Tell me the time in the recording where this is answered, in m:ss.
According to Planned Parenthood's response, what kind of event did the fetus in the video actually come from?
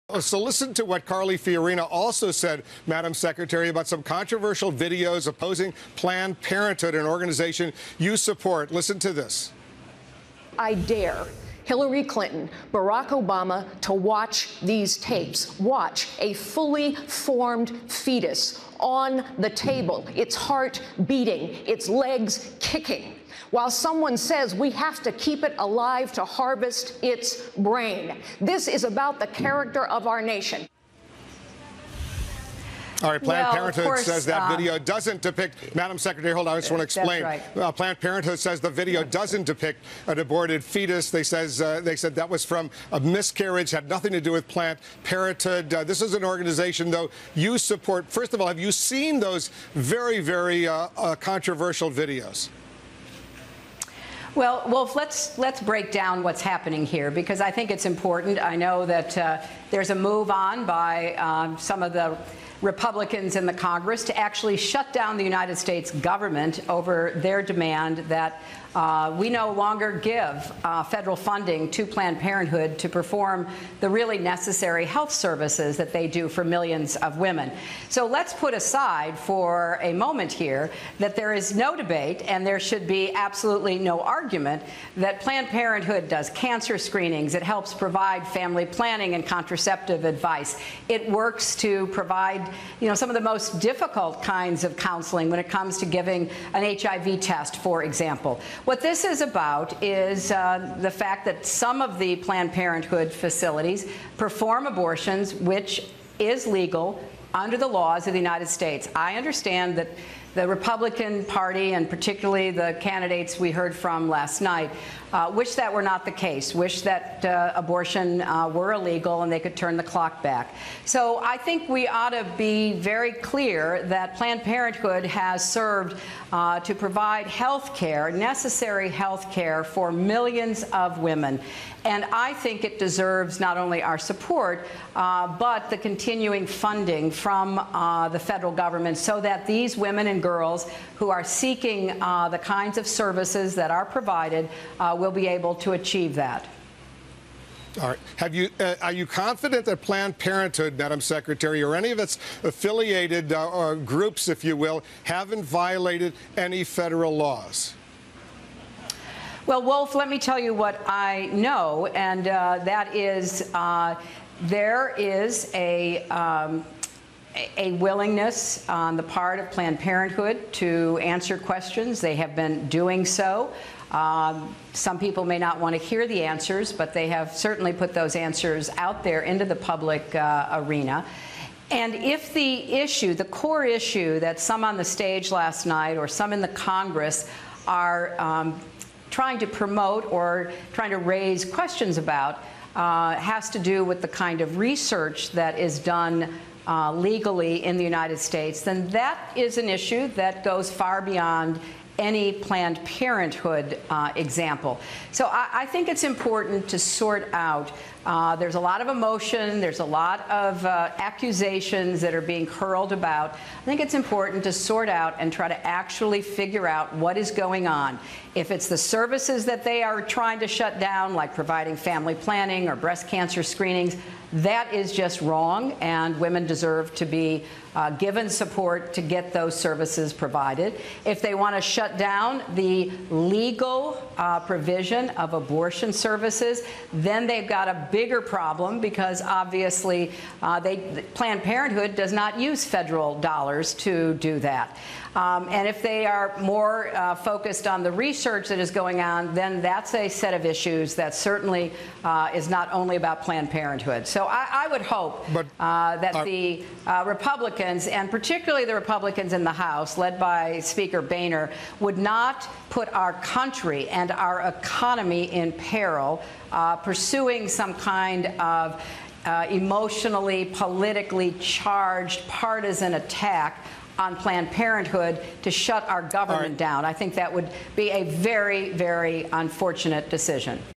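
0:42.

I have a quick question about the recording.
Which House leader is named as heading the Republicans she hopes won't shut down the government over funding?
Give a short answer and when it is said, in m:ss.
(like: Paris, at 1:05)
Speaker Boehner, at 4:20.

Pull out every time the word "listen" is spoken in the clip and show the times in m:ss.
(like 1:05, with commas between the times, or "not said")
0:00, 0:08.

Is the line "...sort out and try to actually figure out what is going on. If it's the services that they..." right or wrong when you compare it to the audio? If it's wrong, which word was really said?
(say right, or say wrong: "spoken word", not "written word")
right.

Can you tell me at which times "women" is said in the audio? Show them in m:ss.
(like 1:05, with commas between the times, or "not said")
1:17, 2:10, 2:19, 3:46.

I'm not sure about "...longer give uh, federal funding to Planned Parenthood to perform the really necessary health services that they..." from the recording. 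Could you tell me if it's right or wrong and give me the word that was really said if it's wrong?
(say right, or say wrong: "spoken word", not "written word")
right.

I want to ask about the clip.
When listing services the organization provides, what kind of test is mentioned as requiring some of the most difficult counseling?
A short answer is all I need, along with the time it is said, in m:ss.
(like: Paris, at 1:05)
HIV test, at 1:36.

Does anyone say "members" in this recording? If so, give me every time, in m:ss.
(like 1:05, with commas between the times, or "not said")
not said.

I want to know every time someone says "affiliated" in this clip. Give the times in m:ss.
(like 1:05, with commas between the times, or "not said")
2:32.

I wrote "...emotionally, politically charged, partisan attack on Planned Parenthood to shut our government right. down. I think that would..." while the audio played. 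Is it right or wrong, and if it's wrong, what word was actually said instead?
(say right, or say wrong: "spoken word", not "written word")
right.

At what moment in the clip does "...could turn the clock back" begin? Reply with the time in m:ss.
1:59.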